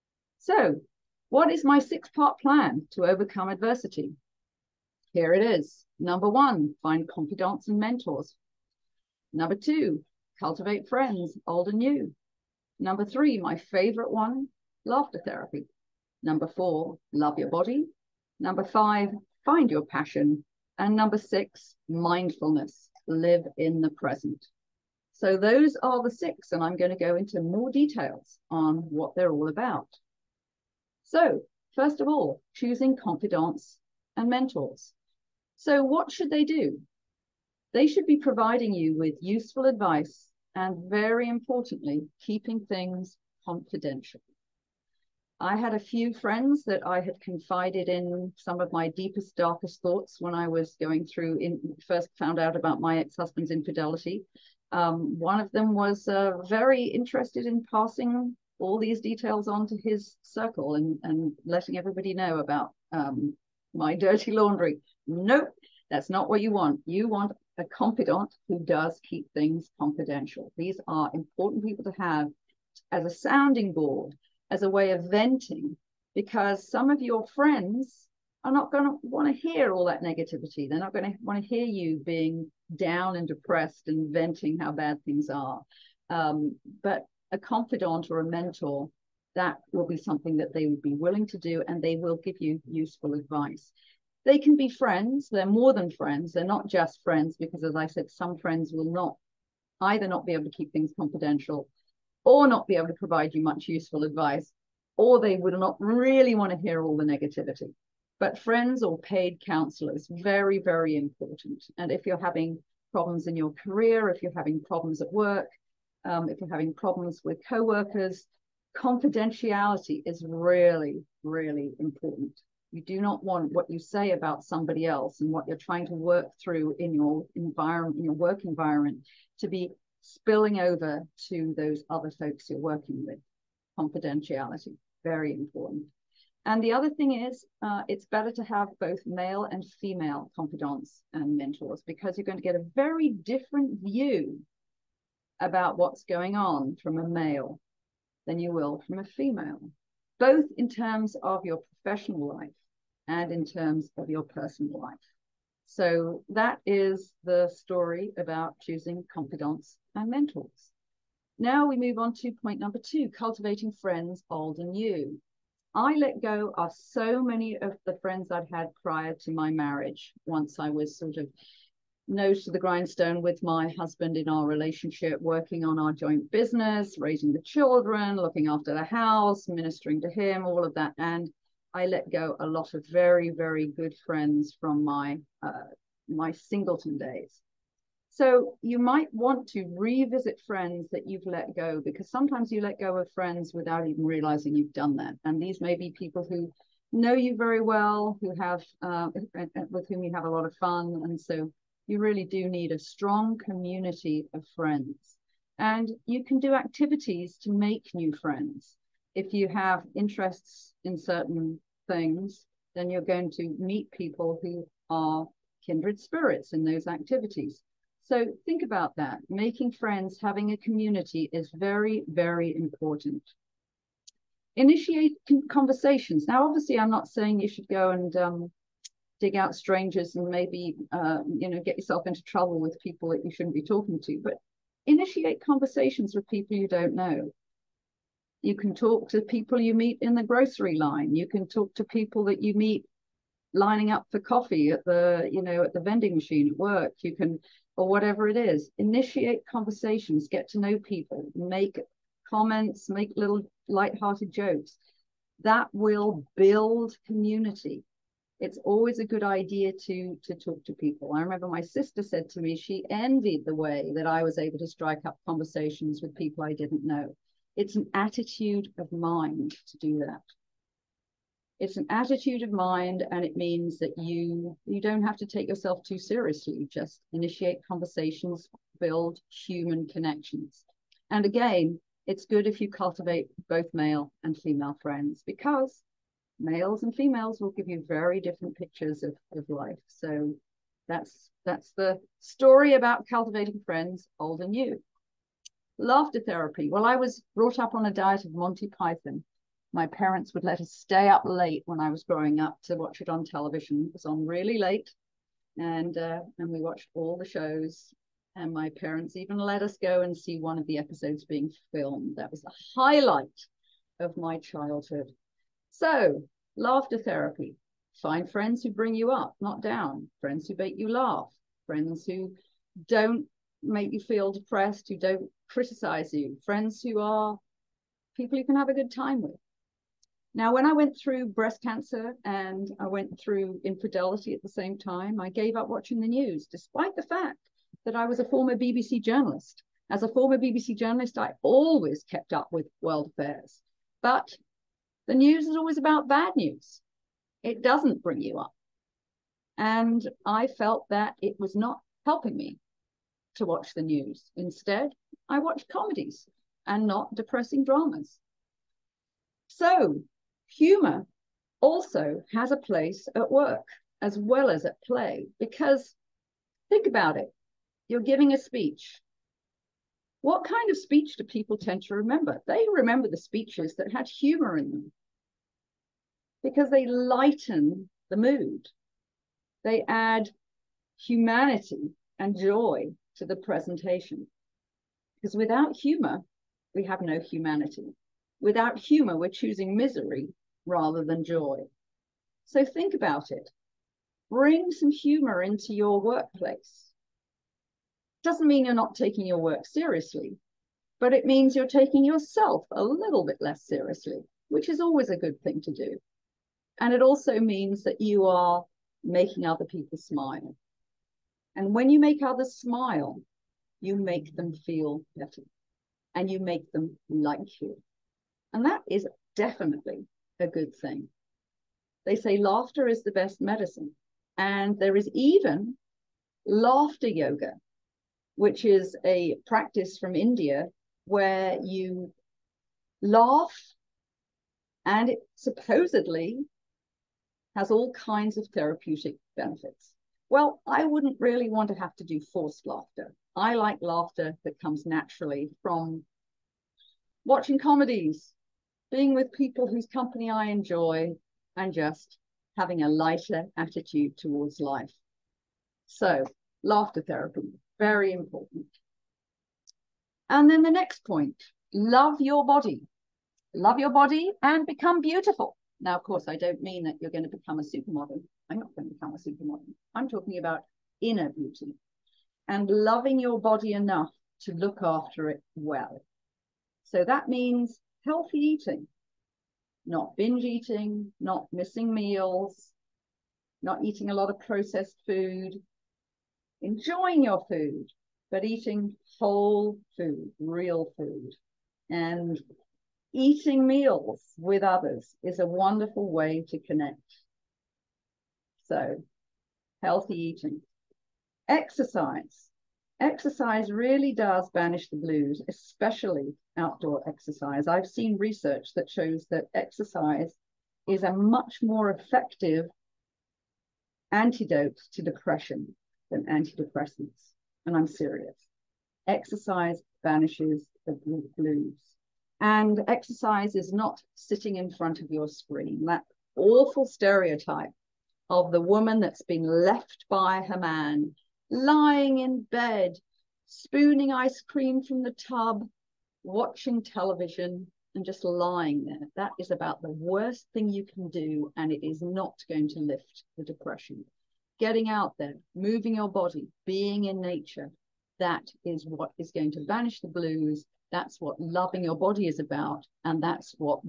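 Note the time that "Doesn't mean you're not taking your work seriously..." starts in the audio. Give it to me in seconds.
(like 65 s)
398 s.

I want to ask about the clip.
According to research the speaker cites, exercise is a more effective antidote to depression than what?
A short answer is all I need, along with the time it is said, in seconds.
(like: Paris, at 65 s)
Antidepressants, at 516 s.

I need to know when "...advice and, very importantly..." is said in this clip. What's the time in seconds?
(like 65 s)
39 s.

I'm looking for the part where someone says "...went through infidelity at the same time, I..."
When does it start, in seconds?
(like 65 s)
332 s.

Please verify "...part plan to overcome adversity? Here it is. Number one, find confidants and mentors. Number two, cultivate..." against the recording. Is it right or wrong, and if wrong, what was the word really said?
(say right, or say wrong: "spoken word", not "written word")
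right.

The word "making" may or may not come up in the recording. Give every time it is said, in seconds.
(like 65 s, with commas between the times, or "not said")
219 s, 409 s.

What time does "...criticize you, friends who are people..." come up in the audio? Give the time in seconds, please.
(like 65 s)
325 s.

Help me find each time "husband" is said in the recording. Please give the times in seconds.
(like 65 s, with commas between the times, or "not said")
52 s, 173 s.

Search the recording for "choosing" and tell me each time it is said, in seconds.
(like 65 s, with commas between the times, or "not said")
32 s, 158 s, 389 s.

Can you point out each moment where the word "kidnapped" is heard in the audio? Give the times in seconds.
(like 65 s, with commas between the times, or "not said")
not said.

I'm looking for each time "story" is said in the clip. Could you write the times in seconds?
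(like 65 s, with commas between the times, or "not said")
157 s, 292 s.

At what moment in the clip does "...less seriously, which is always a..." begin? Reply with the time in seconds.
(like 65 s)
403 s.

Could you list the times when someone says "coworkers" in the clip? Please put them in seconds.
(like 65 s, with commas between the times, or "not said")
117 s.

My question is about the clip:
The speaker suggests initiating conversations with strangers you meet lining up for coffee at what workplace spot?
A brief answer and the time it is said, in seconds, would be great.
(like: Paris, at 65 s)
The vending machine, at 245 s.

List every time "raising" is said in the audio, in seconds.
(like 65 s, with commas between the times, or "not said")
176 s.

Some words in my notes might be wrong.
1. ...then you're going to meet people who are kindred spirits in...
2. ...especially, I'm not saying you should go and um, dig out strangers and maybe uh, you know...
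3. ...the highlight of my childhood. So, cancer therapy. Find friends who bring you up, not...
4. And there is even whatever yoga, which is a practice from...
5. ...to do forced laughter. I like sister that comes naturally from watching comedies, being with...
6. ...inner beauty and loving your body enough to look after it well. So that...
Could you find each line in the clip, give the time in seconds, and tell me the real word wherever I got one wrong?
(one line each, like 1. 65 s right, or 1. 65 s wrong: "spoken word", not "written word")
1. 212 s right
2. 226 s wrong: "obviously", not "especially"
3. 312 s wrong: "laughter", not "cancer"
4. 424 s wrong: "laughter", not "whatever"
5. 441 s wrong: "laughter", not "sister"
6. 470 s right.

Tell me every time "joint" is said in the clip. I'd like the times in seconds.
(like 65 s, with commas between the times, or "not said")
175 s.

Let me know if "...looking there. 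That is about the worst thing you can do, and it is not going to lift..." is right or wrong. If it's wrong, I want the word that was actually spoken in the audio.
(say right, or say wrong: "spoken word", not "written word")
wrong: "lying", not "looking".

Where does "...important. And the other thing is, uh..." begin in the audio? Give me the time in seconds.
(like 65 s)
135 s.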